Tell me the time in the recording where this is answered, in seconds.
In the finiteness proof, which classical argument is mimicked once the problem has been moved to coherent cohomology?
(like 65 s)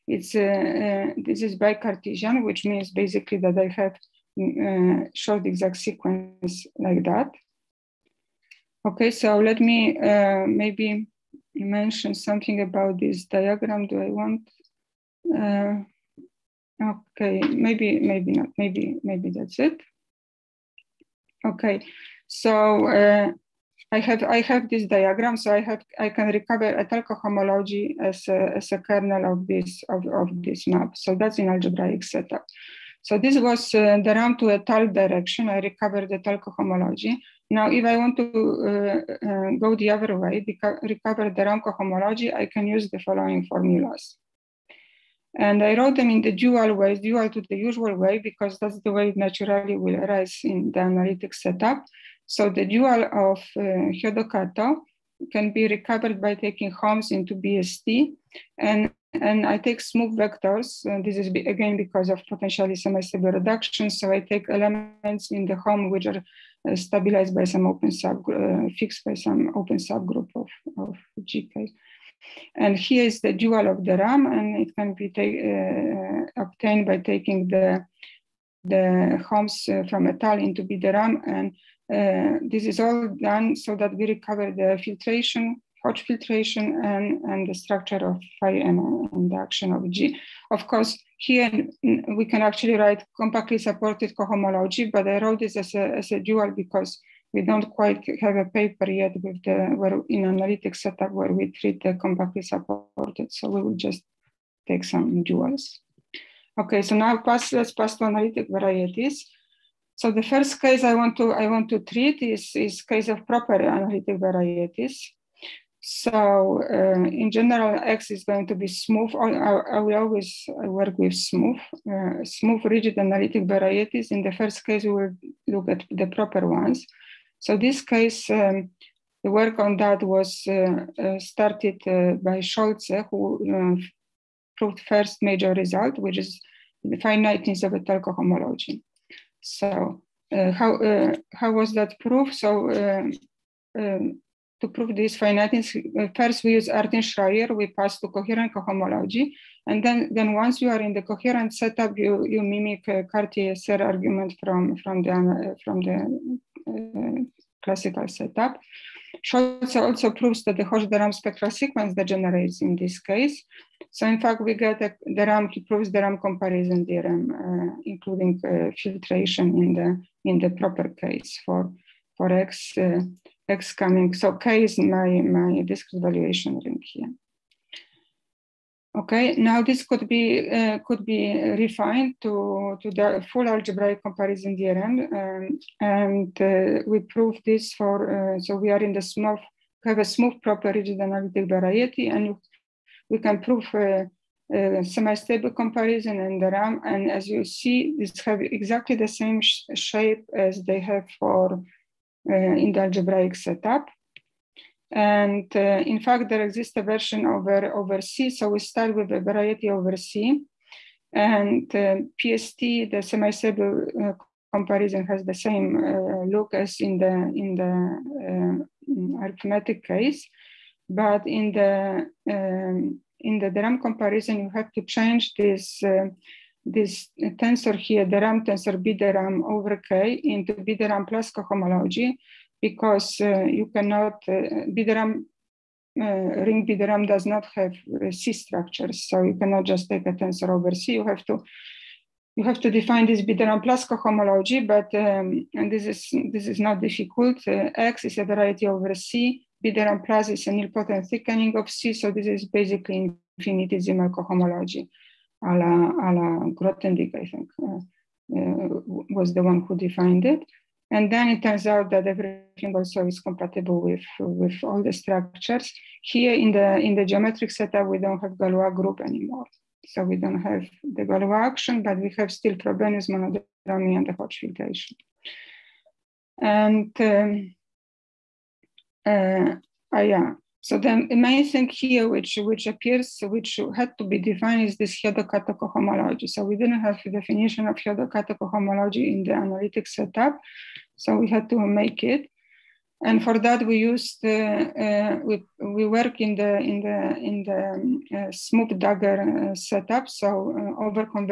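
153 s.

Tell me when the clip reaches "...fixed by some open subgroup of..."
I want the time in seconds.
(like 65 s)
68 s.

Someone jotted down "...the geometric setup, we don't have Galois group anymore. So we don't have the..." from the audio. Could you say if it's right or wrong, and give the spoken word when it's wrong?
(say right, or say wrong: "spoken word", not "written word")
right.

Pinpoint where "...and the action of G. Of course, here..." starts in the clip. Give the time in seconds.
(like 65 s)
89 s.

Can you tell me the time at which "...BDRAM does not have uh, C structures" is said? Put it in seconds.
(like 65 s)
236 s.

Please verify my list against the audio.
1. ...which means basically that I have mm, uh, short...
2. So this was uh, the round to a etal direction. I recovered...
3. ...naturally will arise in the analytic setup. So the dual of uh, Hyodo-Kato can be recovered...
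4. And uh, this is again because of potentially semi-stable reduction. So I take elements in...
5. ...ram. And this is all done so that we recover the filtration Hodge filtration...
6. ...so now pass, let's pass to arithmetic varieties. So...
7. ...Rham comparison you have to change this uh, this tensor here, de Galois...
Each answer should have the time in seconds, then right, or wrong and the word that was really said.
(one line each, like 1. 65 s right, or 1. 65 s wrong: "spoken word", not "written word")
1. 2 s right
2. 33 s right
3. 49 s right
4. 60 s right
5. 80 s right
6. 106 s wrong: "analytic", not "arithmetic"
7. 223 s wrong: "Rham", not "Galois".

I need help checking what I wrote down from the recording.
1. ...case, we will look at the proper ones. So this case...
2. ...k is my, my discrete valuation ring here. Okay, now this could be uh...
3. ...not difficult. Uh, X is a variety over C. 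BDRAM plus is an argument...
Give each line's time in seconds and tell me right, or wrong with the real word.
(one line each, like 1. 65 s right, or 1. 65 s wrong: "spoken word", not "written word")
1. 124 s right
2. 174 s right
3. 246 s wrong: "nilpotent", not "argument".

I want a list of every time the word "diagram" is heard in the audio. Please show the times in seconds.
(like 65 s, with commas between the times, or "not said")
13 s, 24 s.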